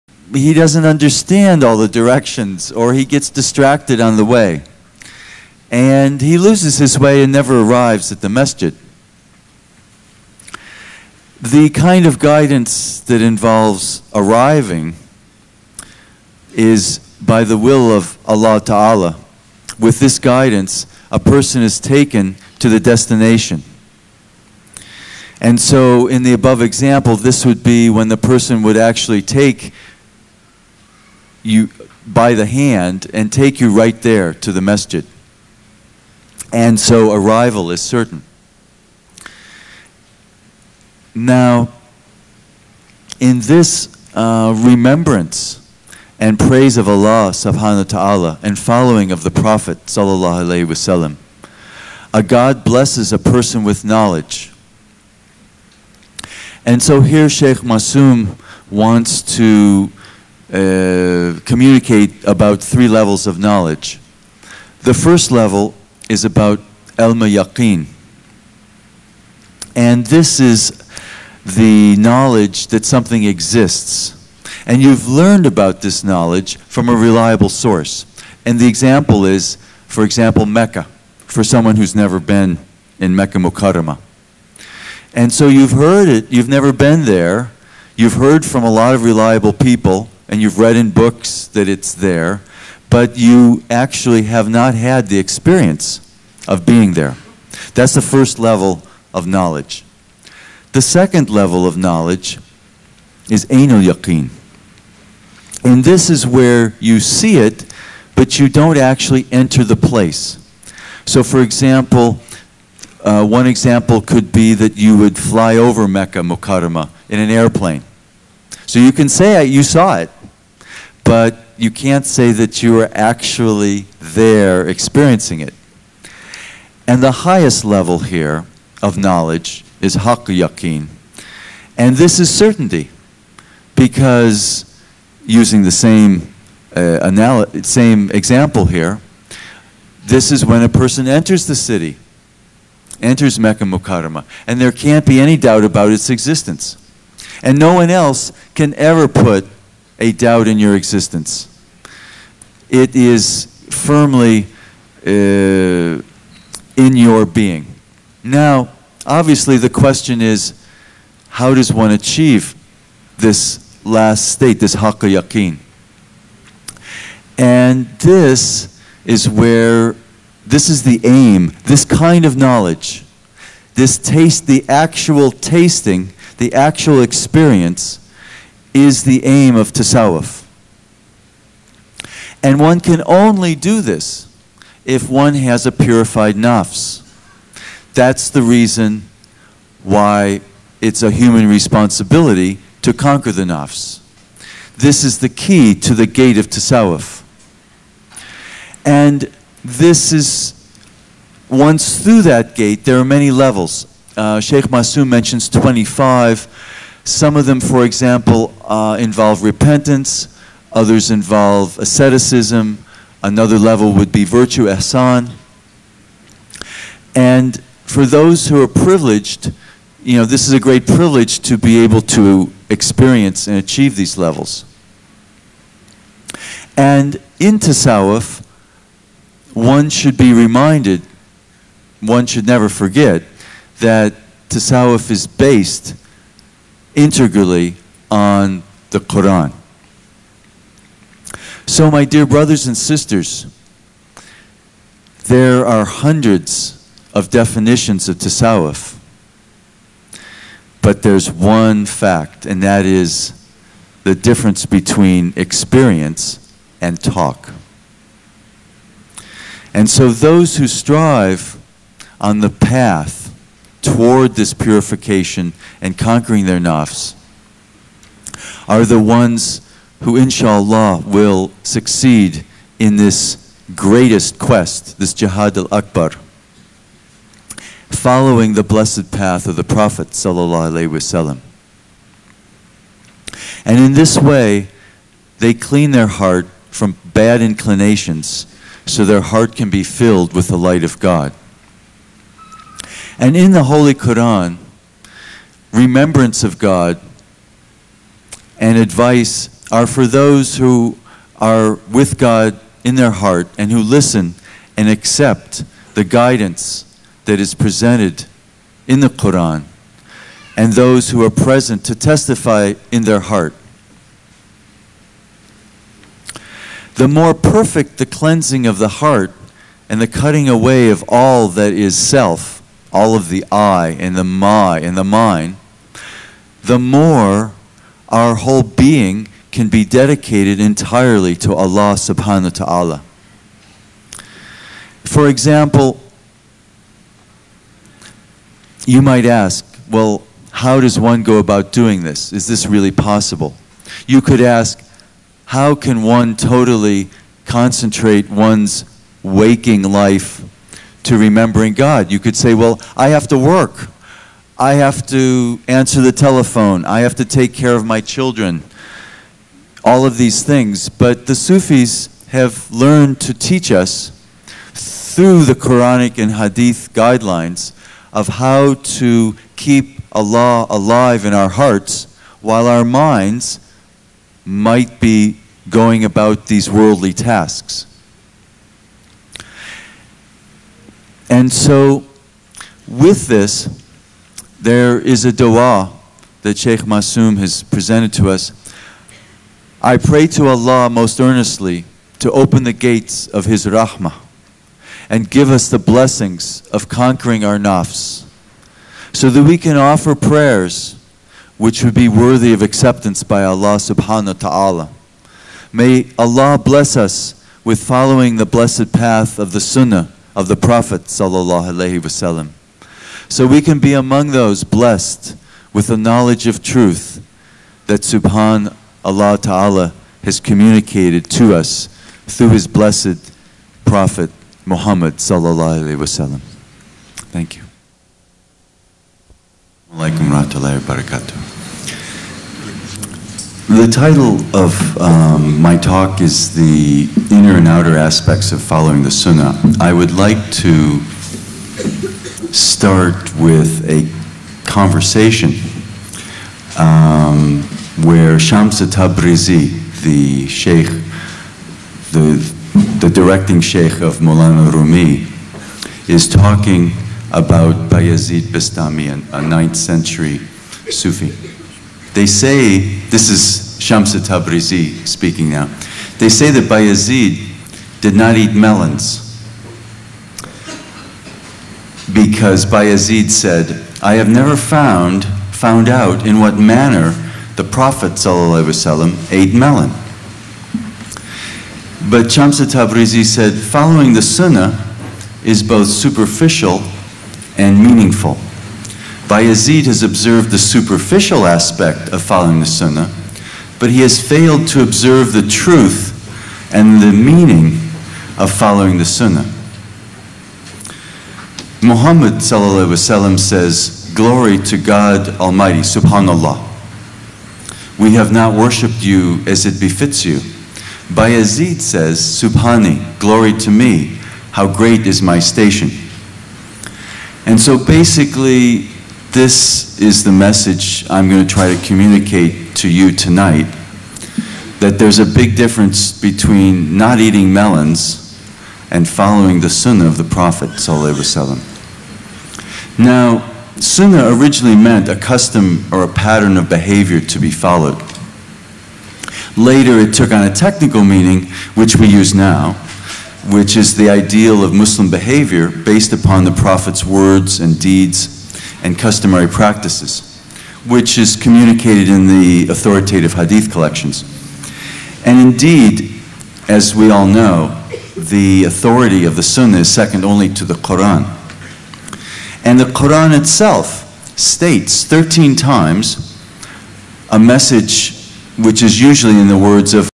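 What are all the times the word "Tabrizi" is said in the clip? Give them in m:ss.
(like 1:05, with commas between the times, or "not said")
7:28, 7:44, 8:02.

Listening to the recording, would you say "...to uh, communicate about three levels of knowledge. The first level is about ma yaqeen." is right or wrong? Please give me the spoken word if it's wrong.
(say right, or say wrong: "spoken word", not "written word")
right.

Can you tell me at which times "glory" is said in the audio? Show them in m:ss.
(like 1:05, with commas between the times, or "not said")
8:24, 8:33.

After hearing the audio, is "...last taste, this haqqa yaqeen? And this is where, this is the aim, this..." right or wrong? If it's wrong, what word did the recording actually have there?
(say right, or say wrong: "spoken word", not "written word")
wrong: "state", not "taste".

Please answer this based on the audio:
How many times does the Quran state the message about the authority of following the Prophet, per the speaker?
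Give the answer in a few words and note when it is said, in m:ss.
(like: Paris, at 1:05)
13, at 9:25.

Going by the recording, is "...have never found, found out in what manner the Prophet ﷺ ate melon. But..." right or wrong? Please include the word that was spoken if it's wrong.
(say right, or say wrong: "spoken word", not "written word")
right.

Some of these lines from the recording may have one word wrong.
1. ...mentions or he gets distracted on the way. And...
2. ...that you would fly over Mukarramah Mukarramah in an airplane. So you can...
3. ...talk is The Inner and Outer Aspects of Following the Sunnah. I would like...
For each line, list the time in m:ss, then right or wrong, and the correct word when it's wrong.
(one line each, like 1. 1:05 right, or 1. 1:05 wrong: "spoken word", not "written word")
1. 0:01 wrong: "directions", not "mentions"
2. 1:54 wrong: "Mecca", not "Mukarramah"
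3. 7:15 right.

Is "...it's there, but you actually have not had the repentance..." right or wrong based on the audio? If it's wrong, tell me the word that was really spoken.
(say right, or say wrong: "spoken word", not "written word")
wrong: "experience", not "repentance".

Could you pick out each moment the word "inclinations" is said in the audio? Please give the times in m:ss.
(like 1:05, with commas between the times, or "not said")
4:47.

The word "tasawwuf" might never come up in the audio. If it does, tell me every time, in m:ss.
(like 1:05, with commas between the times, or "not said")
2:59, 3:16, 3:47, 3:54, 4:08.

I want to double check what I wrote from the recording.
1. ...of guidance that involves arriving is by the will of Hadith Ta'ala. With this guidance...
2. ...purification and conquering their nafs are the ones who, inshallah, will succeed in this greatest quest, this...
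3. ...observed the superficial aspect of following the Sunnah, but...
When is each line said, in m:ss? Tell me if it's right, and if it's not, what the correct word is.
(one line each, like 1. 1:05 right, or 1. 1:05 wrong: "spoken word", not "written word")
1. 0:12 wrong: "Allah", not "Hadith"
2. 4:24 right
3. 8:10 right.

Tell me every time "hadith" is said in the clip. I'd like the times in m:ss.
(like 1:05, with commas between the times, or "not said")
6:06, 9:13.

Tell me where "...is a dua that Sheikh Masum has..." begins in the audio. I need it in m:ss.
6:24.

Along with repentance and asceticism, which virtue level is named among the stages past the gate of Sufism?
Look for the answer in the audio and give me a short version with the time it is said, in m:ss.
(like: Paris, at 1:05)
asan, at 3:34.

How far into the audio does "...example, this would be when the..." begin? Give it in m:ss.
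0:26.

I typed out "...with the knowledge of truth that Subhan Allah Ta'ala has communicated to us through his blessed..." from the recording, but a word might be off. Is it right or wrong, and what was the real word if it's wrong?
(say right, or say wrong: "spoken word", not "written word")
right.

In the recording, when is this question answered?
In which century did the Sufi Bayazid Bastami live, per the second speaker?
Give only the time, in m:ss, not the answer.
7:39.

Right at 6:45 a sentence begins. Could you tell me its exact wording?
May Allah bless us with following the blessed path of the sunnah of the Prophet wasallam.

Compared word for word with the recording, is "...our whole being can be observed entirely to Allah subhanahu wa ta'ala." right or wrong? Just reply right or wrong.
wrong.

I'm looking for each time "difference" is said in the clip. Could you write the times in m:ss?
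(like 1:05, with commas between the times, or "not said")
4:14, 8:45.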